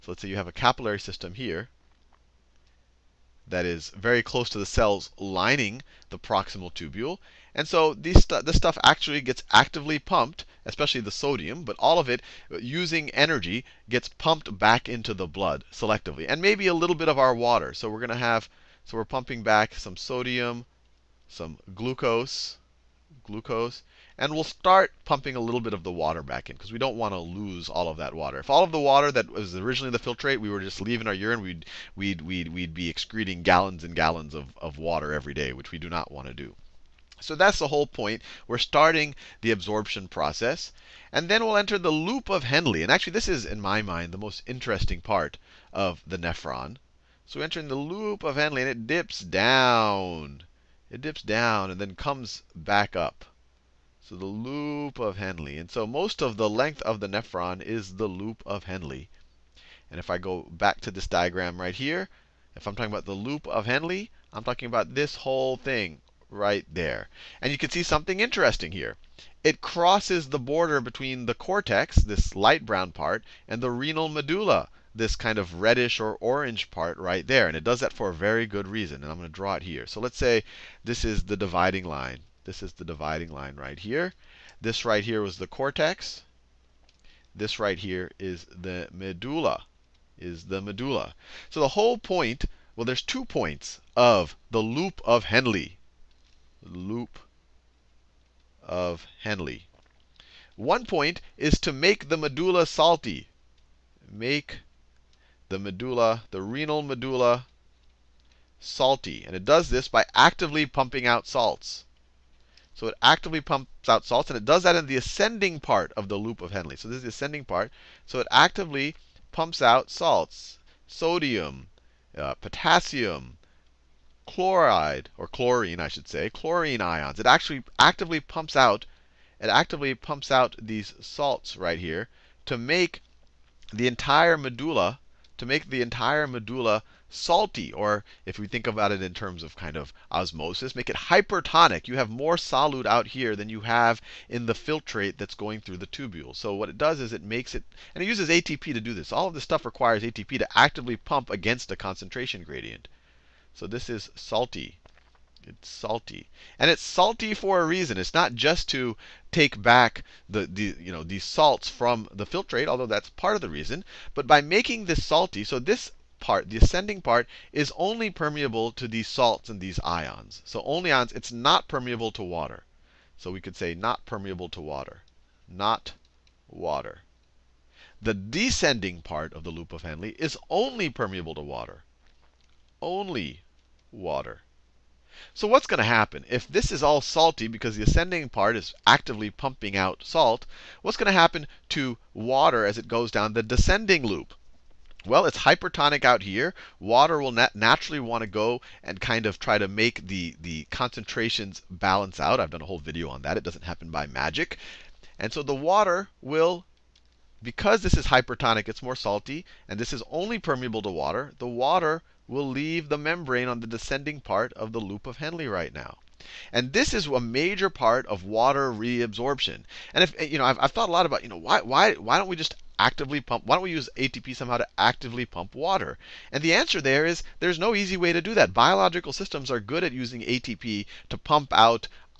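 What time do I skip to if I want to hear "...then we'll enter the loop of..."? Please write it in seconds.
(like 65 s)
41 s.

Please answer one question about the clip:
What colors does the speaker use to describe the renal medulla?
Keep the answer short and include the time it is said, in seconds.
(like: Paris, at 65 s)
reddish or orange, at 75 s.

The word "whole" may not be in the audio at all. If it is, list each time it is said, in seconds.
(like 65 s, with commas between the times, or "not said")
37 s, 65 s, 91 s, 202 s.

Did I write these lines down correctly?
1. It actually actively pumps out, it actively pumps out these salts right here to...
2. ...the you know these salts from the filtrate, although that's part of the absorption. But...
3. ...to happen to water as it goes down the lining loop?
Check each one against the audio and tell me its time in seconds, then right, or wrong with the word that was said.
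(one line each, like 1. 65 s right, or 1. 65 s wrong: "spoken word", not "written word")
1. 127 s right
2. 160 s wrong: "reason", not "absorption"
3. 191 s wrong: "descending", not "lining".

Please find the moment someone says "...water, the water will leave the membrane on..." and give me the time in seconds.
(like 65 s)
210 s.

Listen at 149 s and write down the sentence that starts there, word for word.
All of this stuff requires ATP to actively pump against a concentration gradient.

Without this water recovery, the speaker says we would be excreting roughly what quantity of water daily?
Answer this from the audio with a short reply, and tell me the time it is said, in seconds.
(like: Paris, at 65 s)
gallons and gallons, at 33 s.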